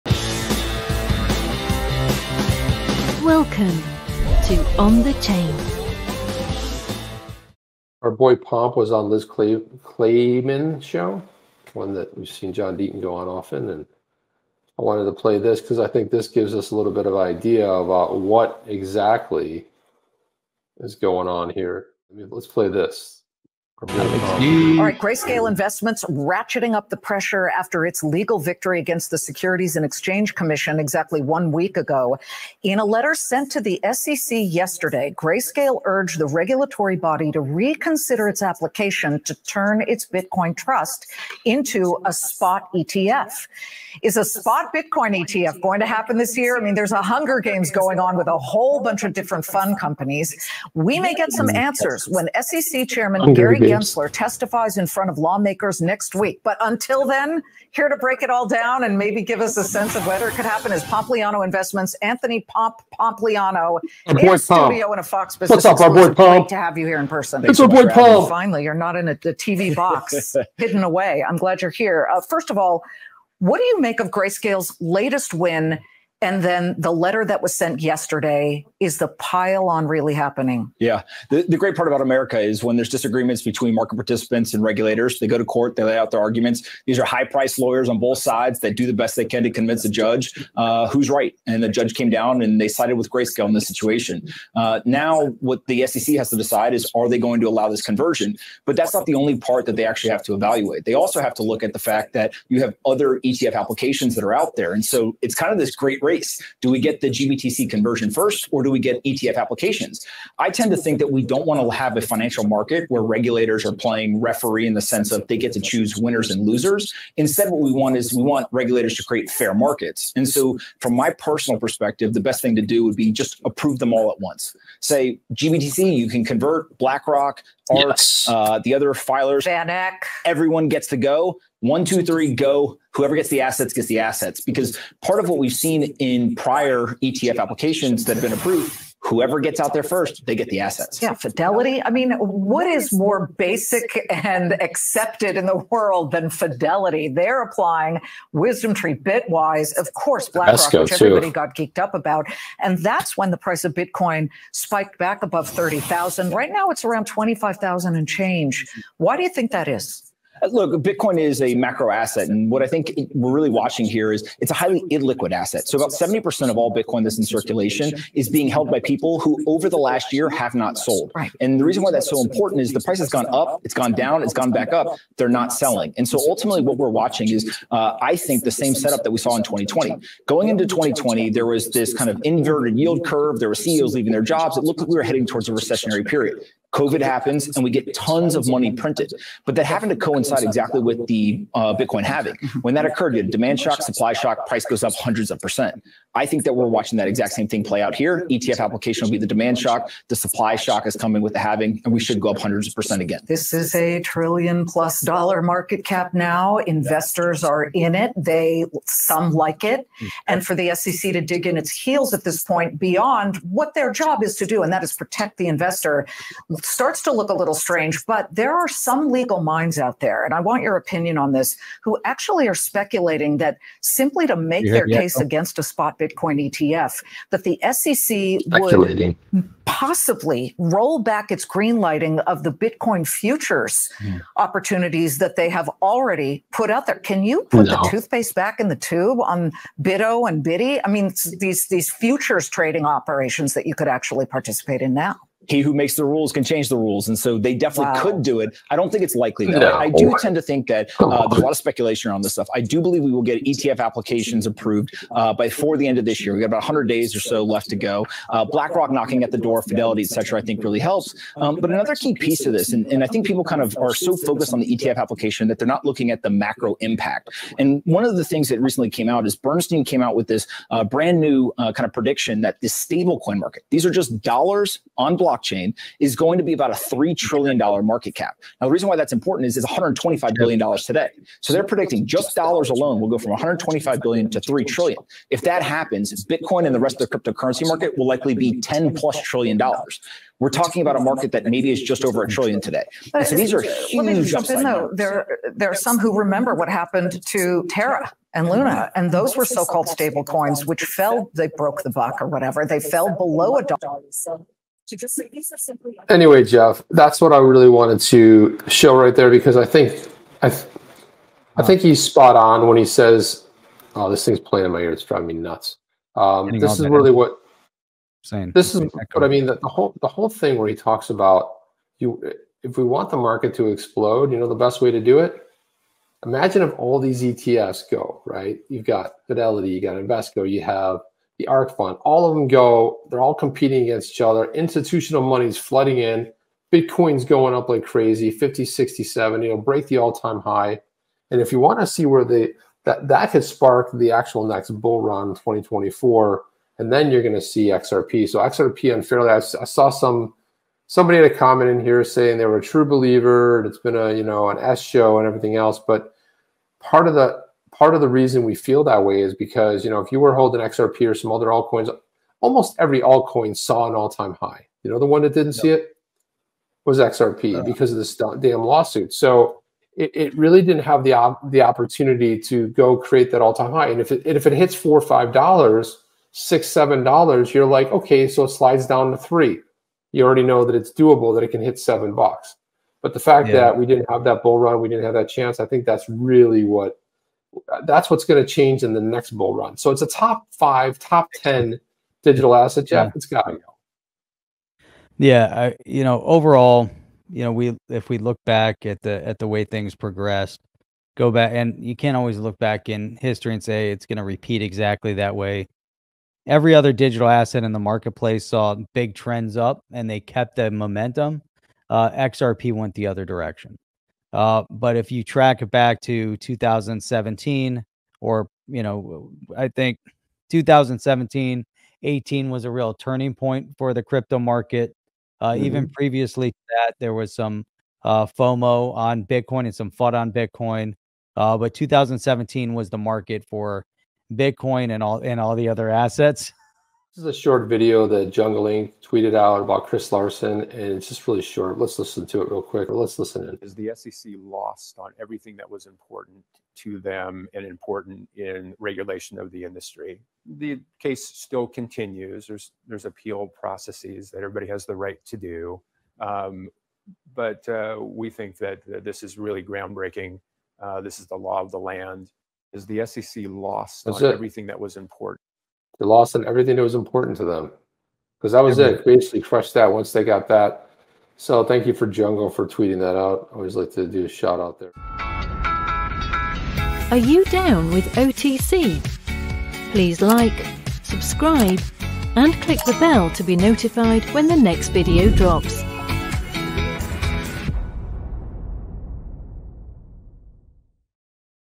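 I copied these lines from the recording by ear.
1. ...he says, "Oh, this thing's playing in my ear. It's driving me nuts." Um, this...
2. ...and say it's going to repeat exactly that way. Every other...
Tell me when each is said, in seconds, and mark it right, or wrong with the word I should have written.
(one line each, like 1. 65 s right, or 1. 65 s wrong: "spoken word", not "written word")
1. 312 s right
2. 403 s right.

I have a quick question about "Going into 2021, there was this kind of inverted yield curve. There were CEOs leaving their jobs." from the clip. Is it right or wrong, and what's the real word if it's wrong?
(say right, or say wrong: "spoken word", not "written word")
wrong: "2020", not "2021".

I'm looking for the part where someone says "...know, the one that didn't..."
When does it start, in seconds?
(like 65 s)
364 s.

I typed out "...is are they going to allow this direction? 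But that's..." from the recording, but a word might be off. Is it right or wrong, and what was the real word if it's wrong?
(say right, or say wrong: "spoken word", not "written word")
wrong: "conversion", not "direction".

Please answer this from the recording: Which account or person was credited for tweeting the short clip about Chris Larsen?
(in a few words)
Jungle Inc.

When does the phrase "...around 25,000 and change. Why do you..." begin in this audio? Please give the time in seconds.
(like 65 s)
156 s.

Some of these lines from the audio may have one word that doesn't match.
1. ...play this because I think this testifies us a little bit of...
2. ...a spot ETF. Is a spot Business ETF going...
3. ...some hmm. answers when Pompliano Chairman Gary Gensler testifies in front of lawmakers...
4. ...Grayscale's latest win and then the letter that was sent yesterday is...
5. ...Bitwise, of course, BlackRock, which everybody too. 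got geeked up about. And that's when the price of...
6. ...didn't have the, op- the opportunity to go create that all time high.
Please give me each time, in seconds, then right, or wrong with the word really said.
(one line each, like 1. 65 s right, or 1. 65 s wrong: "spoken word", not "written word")
1. 15 s wrong: "gives", not "testifies"
2. 42 s wrong: "Bitcoin", not "Business"
3. 51 s wrong: "SEC", not "Pompliano"
4. 74 s right
5. 148 s right
6. 370 s right.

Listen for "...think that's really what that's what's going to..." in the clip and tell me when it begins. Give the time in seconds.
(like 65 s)
385 s.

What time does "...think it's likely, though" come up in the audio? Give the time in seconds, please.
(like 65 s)
248 s.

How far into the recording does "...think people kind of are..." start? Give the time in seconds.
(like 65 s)
263 s.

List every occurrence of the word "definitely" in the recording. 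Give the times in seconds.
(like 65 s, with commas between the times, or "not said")
247 s.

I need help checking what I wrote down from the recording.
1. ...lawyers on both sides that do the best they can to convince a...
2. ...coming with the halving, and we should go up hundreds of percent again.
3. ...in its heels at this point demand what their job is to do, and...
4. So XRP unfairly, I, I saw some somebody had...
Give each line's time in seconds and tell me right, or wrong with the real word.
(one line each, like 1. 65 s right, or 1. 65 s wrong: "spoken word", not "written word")
1. 87 s right
2. 200 s right
3. 211 s wrong: "beyond", not "demand"
4. 348 s right.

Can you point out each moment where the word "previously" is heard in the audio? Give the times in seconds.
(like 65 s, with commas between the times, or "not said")
425 s.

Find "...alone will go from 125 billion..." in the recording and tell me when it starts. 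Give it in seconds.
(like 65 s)
282 s.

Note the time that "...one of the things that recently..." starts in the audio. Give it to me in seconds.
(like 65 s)
267 s.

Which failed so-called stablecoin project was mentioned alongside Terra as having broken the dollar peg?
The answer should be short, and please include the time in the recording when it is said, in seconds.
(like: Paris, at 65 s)
Luna, at 298 s.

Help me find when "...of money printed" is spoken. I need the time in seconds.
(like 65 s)
188 s.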